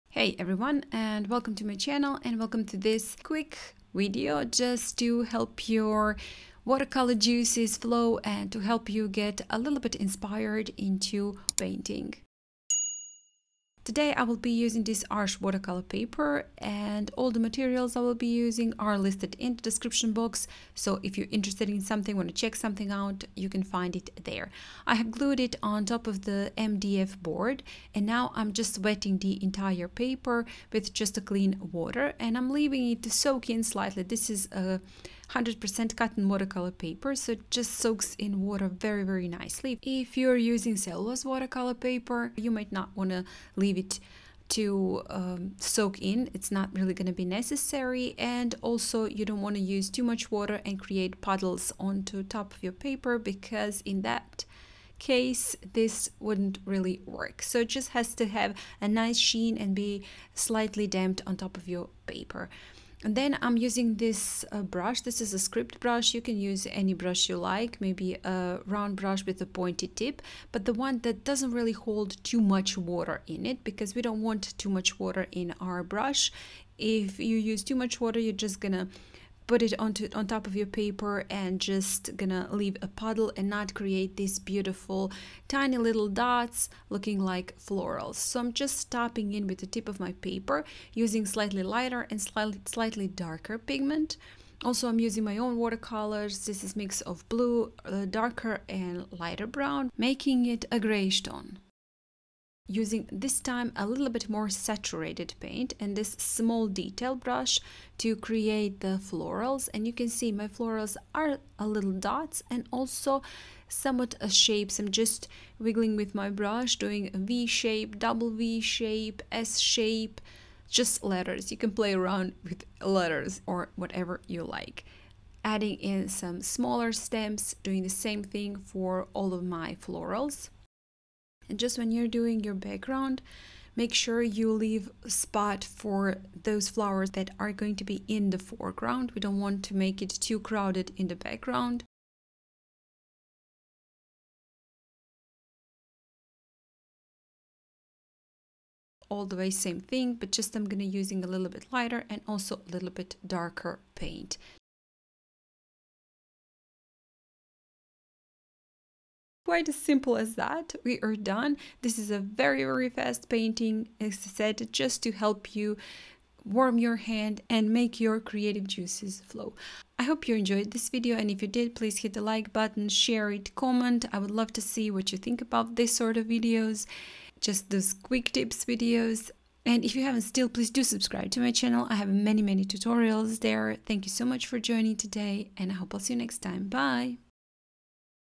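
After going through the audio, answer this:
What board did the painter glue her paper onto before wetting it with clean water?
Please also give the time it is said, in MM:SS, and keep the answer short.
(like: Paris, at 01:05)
MDF board, at 00:26.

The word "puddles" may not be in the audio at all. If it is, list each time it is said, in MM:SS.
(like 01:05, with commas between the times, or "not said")
00:51, 01:22.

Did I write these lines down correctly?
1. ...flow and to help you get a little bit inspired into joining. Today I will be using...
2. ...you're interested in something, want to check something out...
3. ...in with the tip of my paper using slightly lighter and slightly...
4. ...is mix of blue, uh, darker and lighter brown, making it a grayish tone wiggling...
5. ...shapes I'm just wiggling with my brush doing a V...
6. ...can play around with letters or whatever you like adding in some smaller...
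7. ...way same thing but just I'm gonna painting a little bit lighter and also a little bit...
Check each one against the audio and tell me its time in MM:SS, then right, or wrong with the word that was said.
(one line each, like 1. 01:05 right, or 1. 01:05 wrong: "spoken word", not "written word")
1. 00:07 wrong: "painting", not "joining"
2. 00:21 right
3. 01:29 right
4. 01:36 wrong: "using", not "wiggling"
5. 01:54 right
6. 02:01 right
7. 02:29 wrong: "using", not "painting".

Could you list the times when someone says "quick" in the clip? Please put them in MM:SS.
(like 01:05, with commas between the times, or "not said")
00:03, 02:57.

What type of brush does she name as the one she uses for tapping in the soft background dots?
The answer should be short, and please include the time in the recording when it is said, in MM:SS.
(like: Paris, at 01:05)
script brush, at 01:05.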